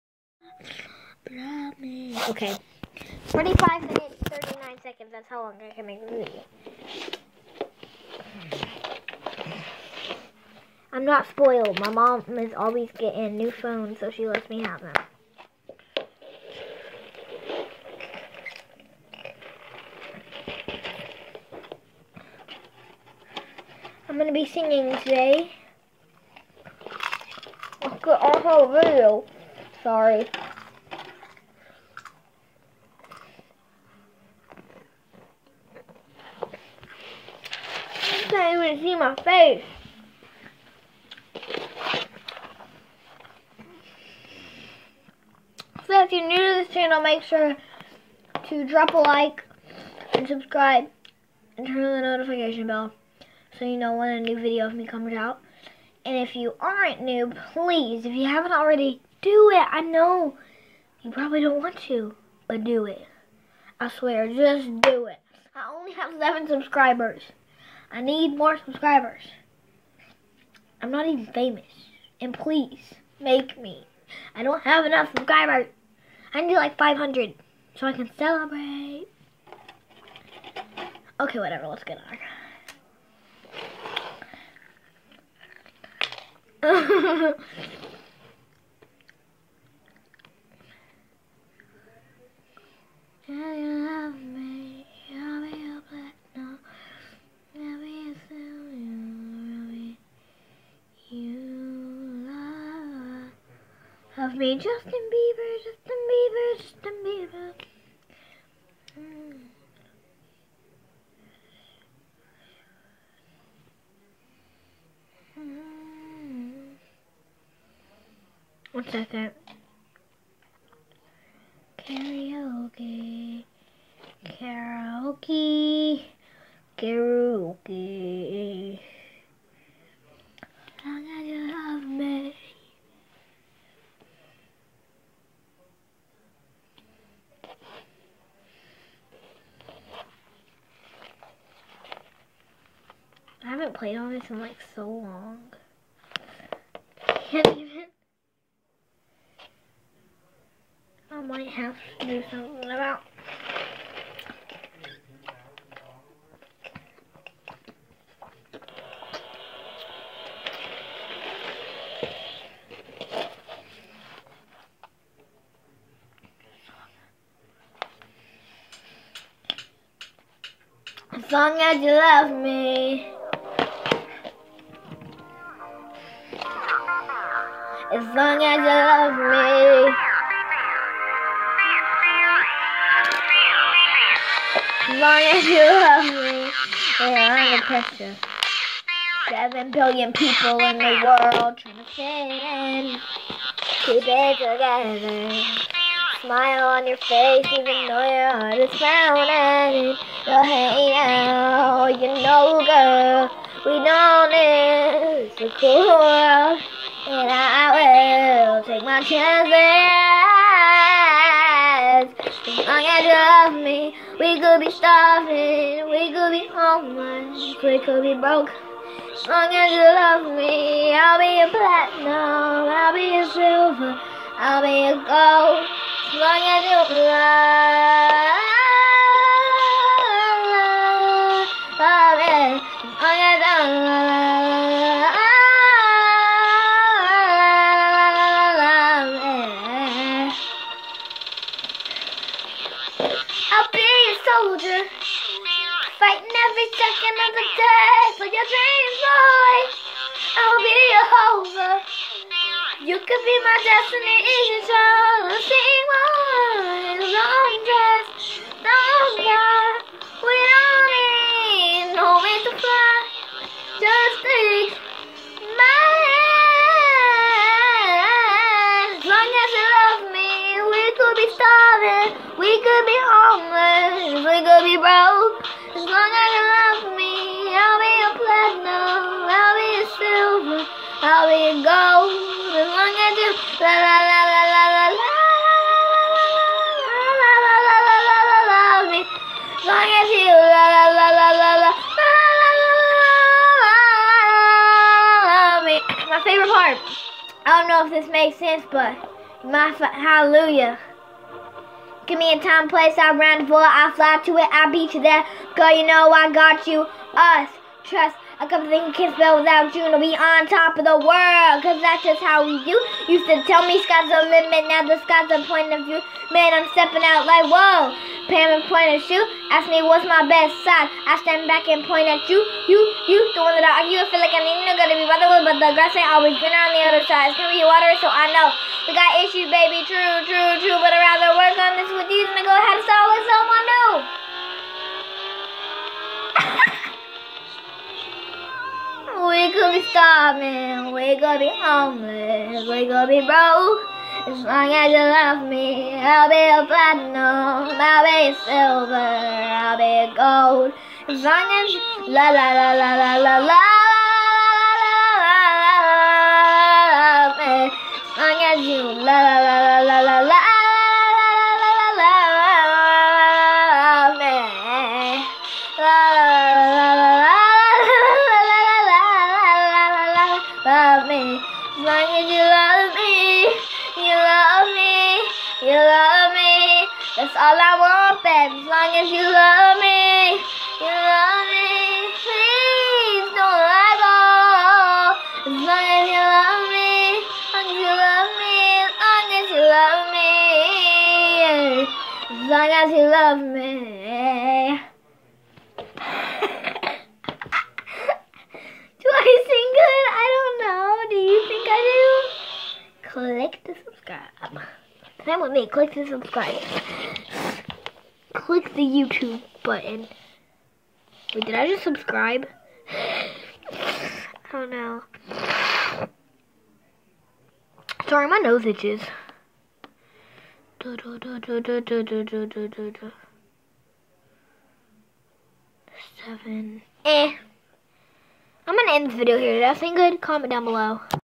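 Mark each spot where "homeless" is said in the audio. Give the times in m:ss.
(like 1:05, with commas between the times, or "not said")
3:36, 4:33, 5:41.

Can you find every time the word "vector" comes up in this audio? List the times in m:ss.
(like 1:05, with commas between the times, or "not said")
not said.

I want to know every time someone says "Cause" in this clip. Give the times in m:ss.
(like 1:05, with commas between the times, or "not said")
5:11.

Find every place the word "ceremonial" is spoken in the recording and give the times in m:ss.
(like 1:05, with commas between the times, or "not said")
not said.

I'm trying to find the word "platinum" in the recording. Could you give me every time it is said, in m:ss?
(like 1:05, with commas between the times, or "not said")
3:41, 4:38, 5:46.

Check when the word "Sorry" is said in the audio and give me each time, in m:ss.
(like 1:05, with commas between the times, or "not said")
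0:29, 6:58.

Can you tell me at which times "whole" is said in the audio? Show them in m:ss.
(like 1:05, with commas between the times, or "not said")
0:28.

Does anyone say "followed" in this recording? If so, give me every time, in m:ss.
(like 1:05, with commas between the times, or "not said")
not said.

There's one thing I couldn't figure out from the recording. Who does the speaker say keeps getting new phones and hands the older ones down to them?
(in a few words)
My mom.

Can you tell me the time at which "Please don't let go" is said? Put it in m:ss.
6:22.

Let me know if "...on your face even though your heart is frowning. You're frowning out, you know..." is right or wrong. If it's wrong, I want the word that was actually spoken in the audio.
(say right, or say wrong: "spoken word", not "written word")
wrong: "hating", not "frowning".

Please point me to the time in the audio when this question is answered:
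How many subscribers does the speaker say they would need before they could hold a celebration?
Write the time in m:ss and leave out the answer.
1:16.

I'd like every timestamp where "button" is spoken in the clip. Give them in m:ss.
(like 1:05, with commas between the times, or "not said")
6:49.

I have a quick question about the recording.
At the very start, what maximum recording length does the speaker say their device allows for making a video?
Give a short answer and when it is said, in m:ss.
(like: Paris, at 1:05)
45 minutes, 39 seconds, at 0:03.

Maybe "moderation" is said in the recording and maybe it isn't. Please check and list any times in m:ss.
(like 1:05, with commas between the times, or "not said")
not said.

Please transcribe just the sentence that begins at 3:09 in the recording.
Seven billion people in the world trying to fit in.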